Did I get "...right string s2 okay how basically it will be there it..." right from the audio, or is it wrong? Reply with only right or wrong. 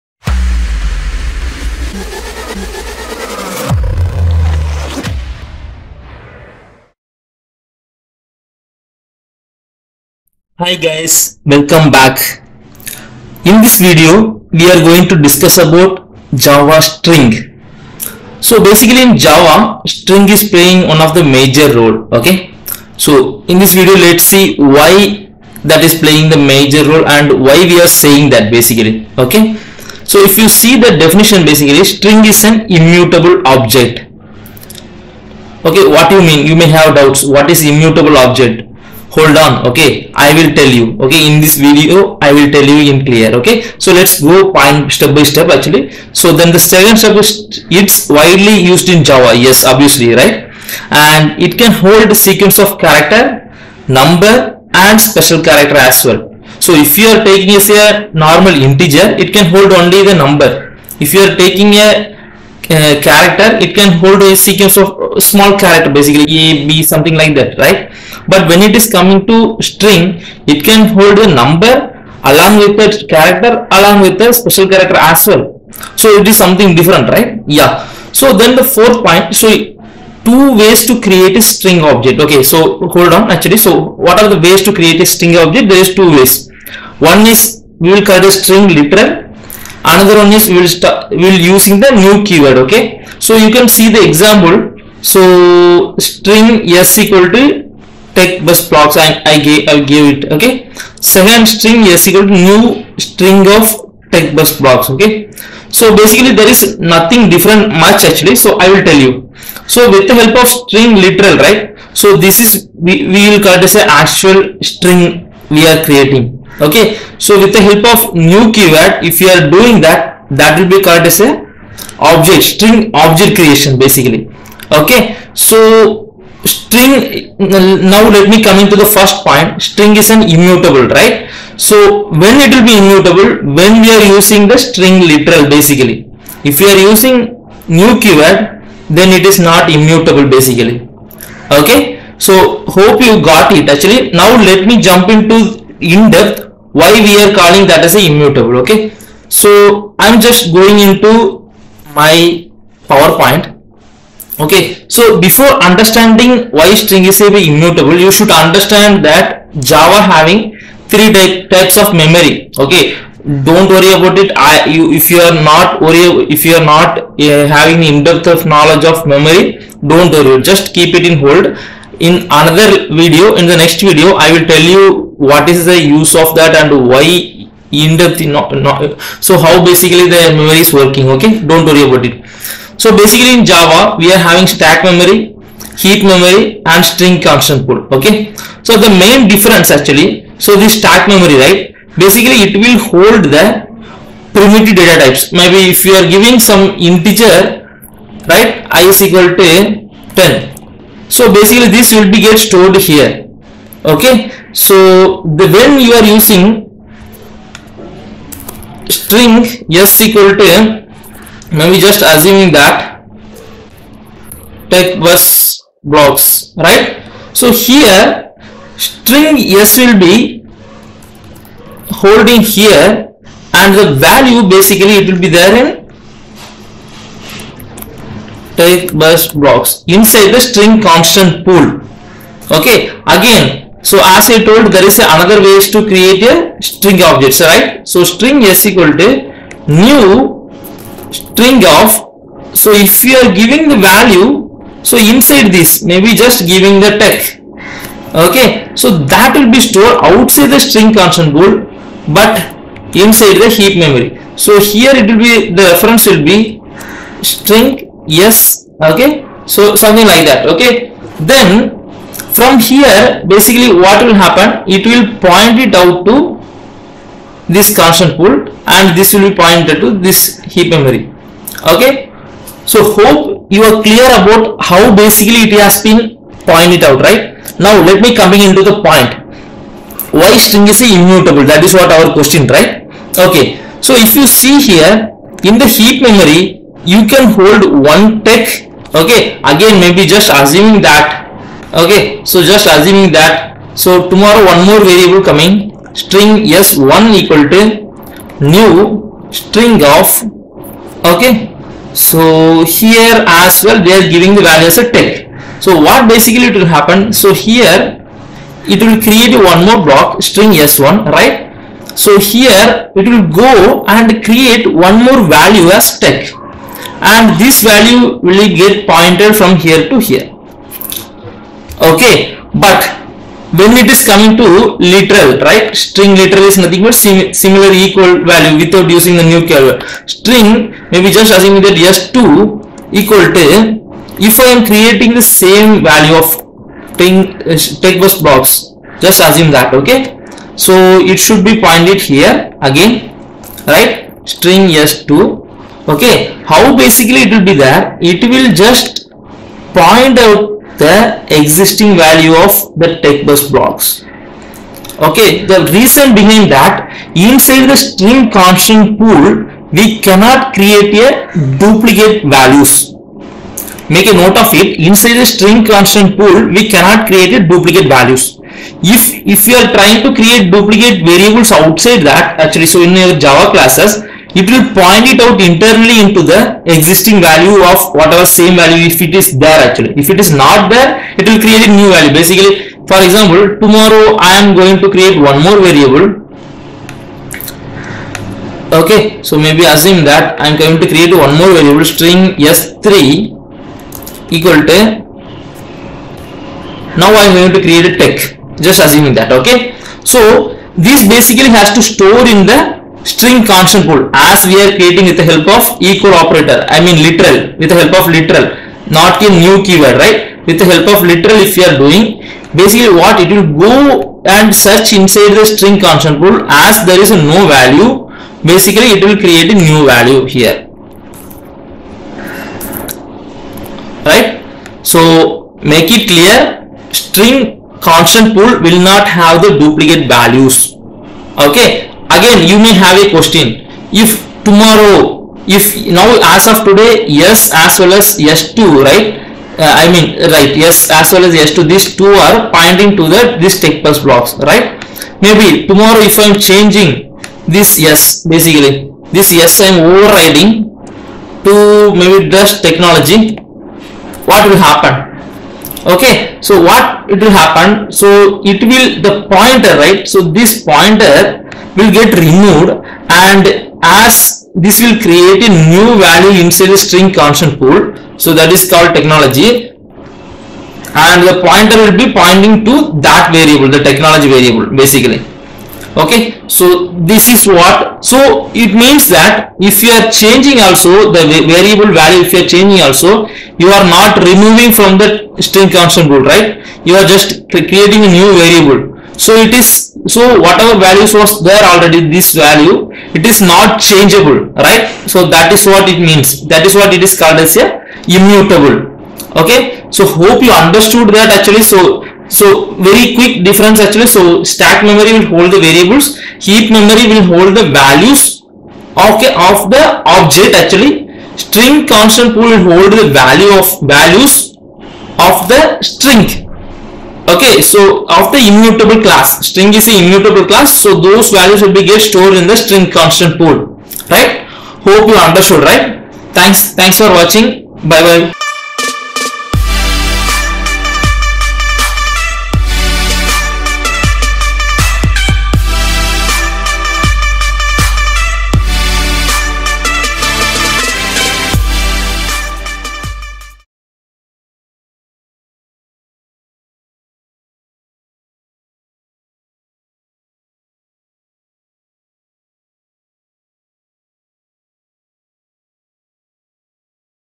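right.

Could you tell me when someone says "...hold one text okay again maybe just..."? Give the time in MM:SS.
04:47.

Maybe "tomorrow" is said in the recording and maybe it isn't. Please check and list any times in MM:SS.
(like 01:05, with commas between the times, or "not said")
04:54, 06:23, 07:14, 07:25.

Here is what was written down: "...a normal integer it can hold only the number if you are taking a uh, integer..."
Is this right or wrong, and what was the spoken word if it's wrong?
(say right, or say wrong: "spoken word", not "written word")
wrong: "character", not "integer".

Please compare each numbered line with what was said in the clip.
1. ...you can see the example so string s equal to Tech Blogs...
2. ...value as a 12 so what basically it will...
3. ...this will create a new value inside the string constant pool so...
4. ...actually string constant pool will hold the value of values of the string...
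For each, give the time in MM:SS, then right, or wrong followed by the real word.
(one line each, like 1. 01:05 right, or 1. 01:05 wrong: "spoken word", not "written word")
1. 01:33 wrong: "Buzz", not "Blogs"
2. 05:04 wrong: "10", not "12"
3. 07:44 right
4. 08:30 right.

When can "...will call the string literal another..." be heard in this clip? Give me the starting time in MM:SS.
01:27.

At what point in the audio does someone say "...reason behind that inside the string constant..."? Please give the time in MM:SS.
05:55.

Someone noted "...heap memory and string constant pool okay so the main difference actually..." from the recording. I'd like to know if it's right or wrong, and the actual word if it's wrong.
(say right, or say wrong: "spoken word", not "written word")
right.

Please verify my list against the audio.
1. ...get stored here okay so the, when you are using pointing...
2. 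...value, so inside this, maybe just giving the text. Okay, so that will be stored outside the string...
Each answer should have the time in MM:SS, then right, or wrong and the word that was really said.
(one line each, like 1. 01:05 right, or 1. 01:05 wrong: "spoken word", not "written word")
1. 03:22 wrong: "string", not "pointing"
2. 04:03 right.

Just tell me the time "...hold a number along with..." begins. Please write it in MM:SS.
01:10.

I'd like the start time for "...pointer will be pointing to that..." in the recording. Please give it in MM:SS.
07:51.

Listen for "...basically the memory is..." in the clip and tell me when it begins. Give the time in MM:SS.
02:59.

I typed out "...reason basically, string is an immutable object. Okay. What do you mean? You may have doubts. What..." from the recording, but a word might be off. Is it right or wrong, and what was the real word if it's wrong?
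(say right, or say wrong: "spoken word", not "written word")
wrong: "definition", not "reason".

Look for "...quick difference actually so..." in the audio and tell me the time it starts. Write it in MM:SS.
08:23.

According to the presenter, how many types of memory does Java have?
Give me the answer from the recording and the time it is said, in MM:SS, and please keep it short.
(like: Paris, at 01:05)
3, at 02:40.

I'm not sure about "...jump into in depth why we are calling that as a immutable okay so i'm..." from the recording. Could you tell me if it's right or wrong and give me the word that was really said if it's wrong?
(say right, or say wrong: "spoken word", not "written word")
right.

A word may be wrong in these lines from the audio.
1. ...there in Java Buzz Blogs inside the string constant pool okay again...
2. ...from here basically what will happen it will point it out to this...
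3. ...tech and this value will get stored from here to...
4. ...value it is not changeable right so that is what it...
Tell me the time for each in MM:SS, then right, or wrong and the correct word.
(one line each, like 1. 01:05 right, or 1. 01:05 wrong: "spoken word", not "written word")
1. 03:45 wrong: "Tech", not "Java"
2. 04:22 right
3. 05:15 wrong: "pointed", not "stored"
4. 08:12 right.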